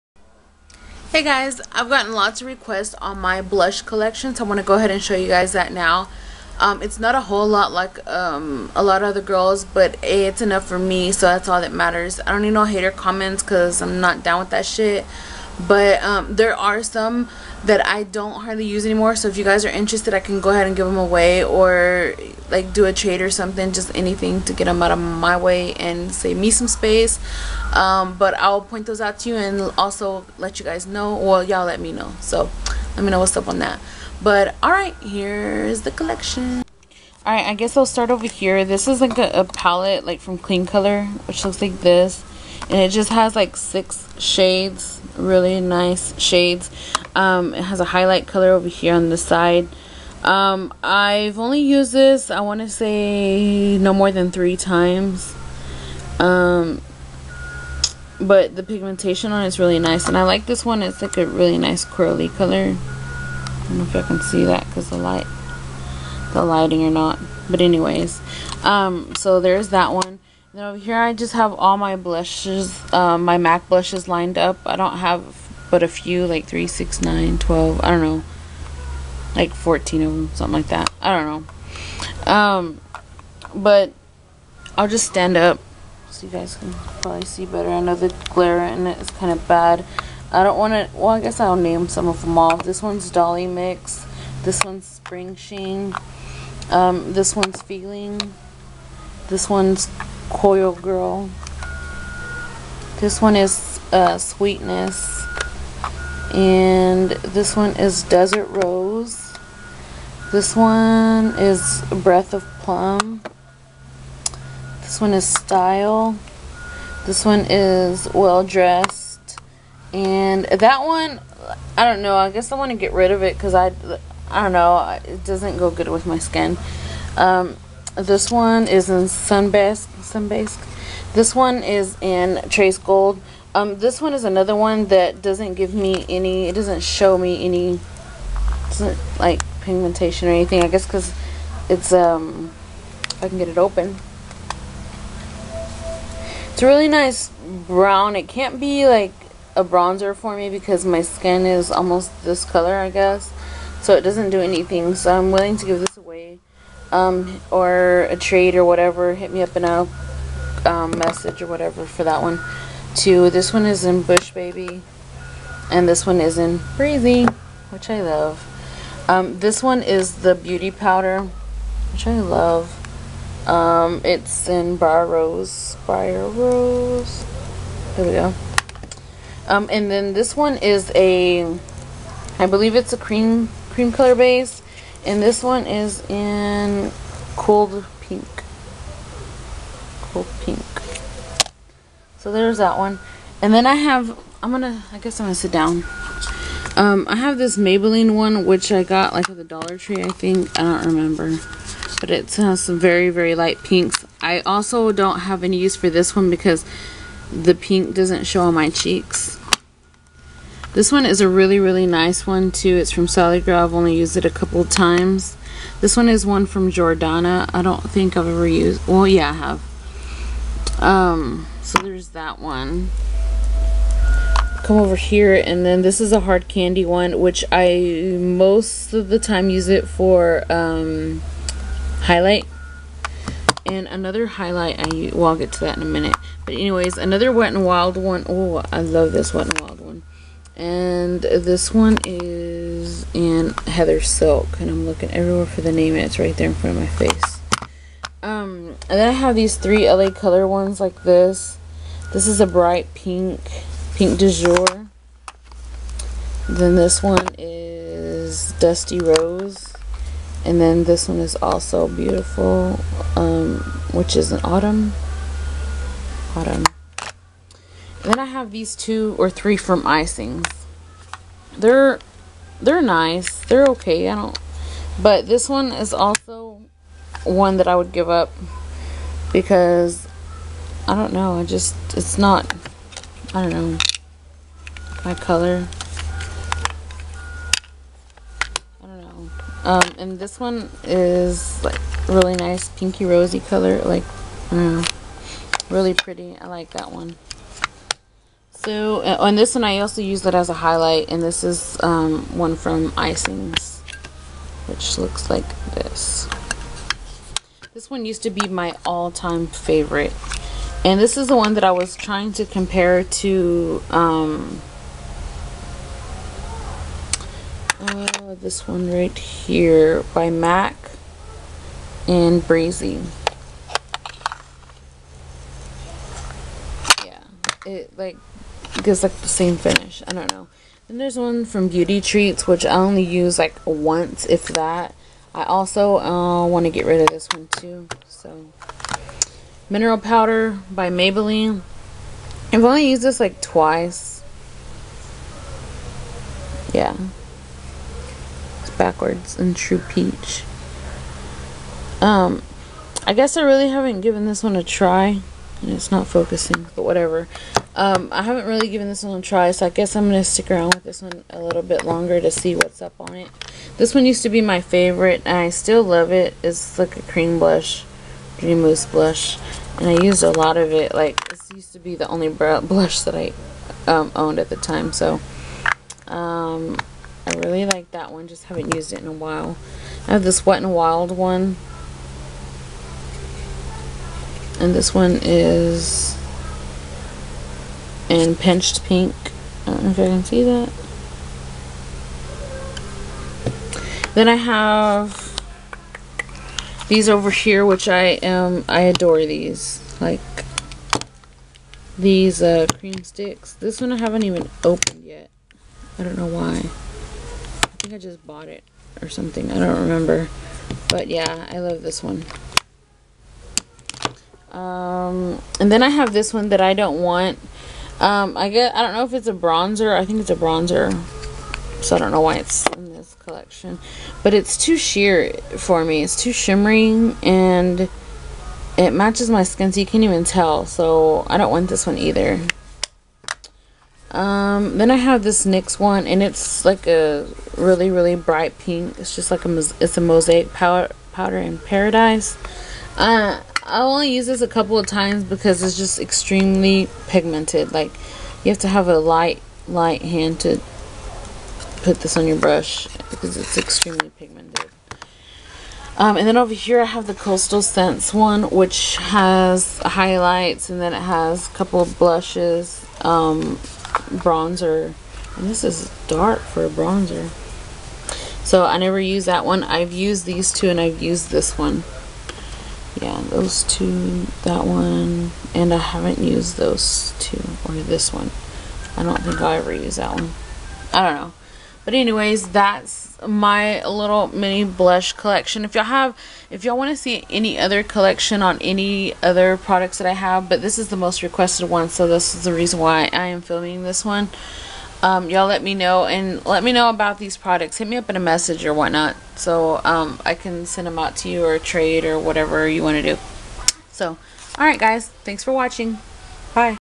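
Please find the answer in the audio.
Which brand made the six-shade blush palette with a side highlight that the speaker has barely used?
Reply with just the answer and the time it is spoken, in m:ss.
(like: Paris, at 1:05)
Kleancolor, at 0:40.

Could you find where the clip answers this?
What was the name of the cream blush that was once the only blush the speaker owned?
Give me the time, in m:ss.
6:08.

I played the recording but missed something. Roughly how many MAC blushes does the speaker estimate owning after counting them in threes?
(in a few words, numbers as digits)
14.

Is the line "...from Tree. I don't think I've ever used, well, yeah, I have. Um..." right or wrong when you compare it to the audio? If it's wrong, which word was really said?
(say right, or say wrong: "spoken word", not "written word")
wrong: "Jordana", not "Tree".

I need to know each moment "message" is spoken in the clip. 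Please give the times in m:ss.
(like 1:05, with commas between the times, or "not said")
2:40, 8:18.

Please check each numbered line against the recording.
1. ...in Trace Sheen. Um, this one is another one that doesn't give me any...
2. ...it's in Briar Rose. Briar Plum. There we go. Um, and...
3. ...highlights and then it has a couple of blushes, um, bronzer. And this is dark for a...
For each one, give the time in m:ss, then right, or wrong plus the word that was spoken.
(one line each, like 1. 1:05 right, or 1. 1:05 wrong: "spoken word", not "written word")
1. 2:12 wrong: "Gold", not "Sheen"
2. 2:54 wrong: "Rose", not "Plum"
3. 7:39 right.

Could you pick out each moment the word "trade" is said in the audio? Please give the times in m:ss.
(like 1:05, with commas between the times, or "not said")
0:22, 2:38, 8:21.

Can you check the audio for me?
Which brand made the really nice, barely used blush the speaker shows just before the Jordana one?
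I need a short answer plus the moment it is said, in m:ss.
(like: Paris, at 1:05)
Sally Girl, at 3:33.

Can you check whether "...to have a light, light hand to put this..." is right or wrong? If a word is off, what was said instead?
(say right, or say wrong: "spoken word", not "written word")
right.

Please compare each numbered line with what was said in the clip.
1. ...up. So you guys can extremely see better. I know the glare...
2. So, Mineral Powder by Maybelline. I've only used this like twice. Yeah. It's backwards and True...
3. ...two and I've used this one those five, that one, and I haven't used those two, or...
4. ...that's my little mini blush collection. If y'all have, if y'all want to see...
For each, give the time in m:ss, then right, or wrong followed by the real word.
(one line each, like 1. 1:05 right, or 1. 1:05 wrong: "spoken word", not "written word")
1. 1:25 wrong: "probably", not "extremely"
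2. 5:38 right
3. 7:50 wrong: "two", not "five"
4. 8:02 right.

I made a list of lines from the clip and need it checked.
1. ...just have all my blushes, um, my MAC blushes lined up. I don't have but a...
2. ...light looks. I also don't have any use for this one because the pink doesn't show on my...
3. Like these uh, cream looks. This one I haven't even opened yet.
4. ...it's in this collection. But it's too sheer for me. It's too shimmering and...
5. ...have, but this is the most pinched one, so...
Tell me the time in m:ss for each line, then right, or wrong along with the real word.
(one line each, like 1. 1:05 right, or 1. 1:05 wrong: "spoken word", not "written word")
1. 1:11 right
2. 3:23 wrong: "pinks", not "looks"
3. 6:40 wrong: "sticks", not "looks"
4. 7:02 right
5. 8:10 wrong: "requested", not "pinched".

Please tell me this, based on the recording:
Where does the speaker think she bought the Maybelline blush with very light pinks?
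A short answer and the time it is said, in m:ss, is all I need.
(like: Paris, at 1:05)
Dollar Tree, at 3:19.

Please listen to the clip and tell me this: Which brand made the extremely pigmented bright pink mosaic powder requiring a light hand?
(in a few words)
NYX.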